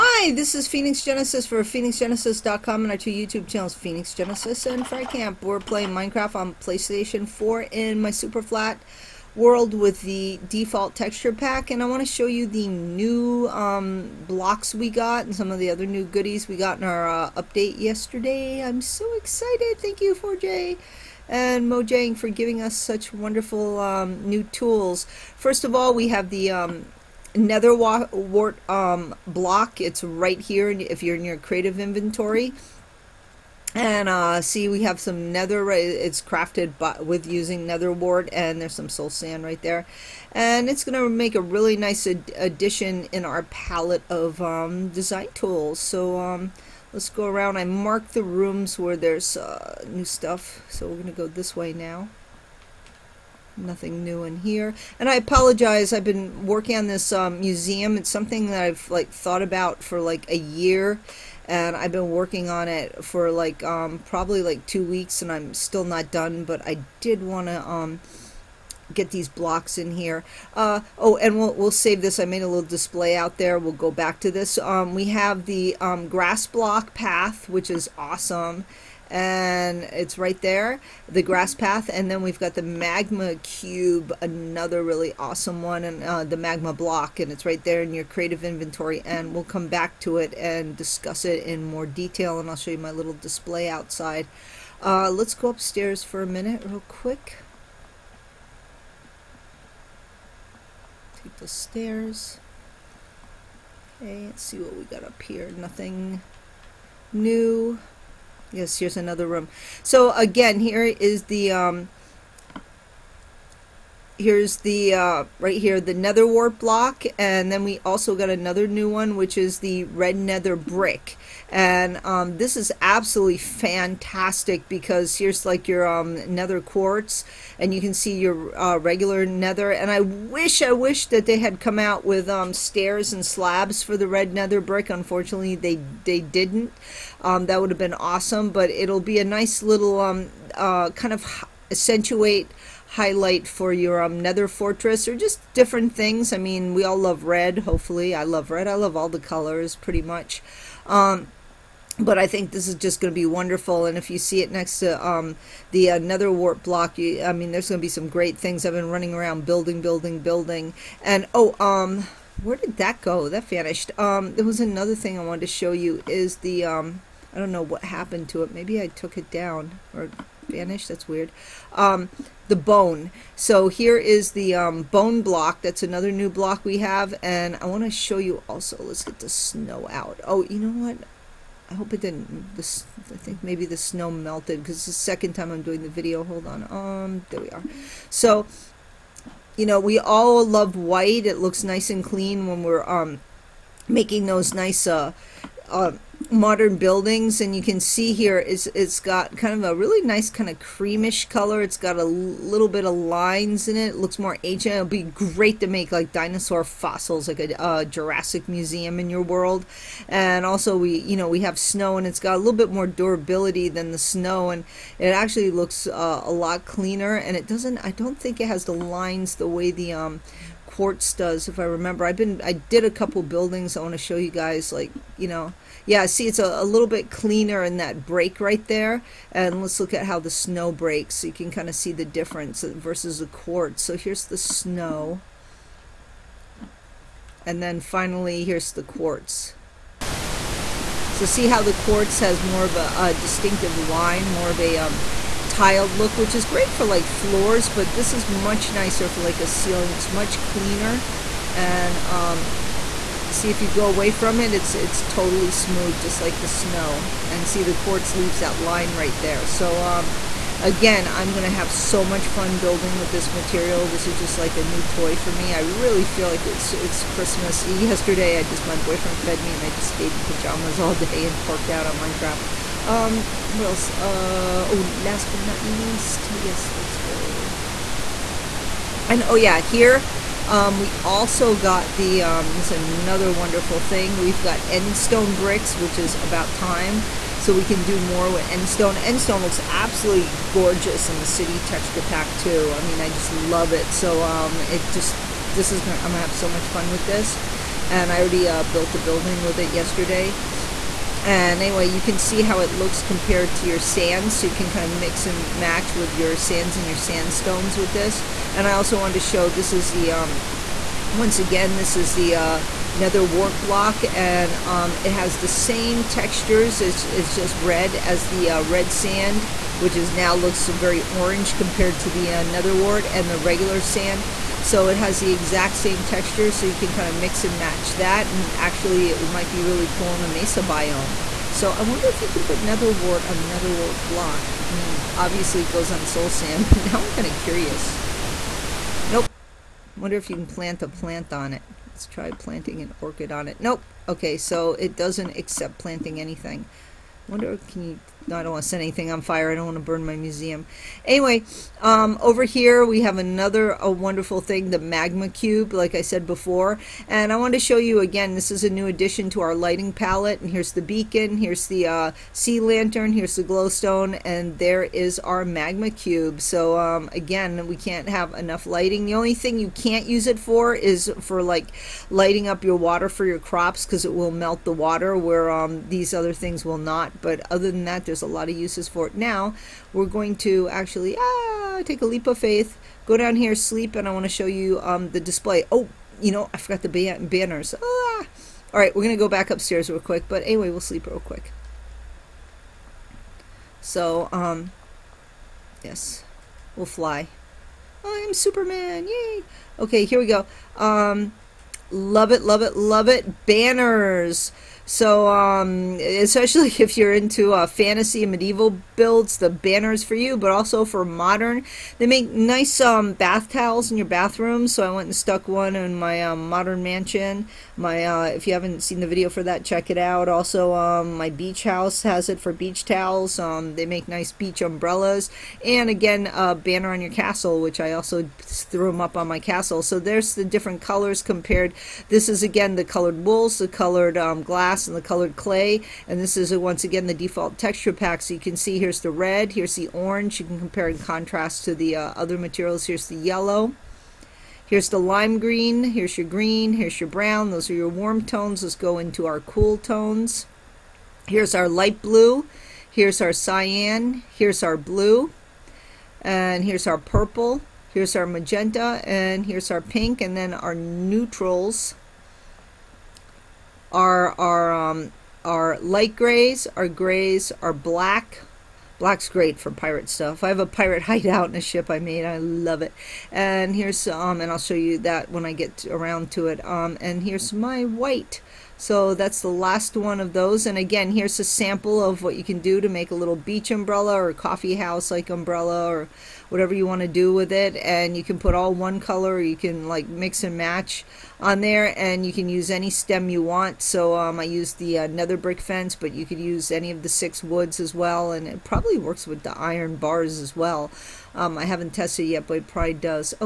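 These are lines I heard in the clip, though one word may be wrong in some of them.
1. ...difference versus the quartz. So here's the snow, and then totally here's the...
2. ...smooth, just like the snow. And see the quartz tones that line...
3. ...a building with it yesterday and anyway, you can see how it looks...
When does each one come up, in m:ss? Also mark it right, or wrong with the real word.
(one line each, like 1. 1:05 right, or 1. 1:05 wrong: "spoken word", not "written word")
1. 3:52 wrong: "finally", not "totally"
2. 4:15 wrong: "leaves", not "tones"
3. 4:58 right.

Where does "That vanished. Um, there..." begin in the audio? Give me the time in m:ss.
2:43.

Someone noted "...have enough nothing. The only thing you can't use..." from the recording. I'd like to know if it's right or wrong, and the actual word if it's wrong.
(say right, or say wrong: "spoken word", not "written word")
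wrong: "lighting", not "nothing".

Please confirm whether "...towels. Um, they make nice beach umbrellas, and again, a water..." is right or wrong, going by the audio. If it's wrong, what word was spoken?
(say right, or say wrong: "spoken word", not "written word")
wrong: "banner", not "water".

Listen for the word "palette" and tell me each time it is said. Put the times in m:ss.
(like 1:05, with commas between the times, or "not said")
0:43, 5:59.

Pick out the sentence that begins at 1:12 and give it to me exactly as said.
I made a little display out there.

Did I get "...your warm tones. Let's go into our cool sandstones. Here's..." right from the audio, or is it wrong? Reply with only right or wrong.
wrong.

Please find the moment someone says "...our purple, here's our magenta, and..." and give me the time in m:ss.
7:36.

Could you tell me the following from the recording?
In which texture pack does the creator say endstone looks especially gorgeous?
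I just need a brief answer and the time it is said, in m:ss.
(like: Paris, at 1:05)
city texture pack, at 4:51.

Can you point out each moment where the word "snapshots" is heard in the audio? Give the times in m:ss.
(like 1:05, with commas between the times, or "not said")
not said.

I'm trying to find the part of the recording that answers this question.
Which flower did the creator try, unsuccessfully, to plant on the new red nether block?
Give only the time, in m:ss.
5:43.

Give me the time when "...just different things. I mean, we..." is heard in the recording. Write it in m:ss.
2:25.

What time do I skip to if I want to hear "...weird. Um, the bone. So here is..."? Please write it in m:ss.
2:51.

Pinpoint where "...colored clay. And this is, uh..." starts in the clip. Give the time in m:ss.
7:15.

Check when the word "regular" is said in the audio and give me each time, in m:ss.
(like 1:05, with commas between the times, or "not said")
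2:08, 5:23.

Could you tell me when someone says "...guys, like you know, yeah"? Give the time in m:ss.
3:44.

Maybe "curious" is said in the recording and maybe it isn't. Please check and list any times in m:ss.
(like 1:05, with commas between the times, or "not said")
5:37.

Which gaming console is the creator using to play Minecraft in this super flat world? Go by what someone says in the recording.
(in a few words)
PlayStation 4.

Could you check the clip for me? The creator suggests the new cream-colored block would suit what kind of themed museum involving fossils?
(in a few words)
Jurassic museum.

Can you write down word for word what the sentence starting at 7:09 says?
So there's the different colors compared.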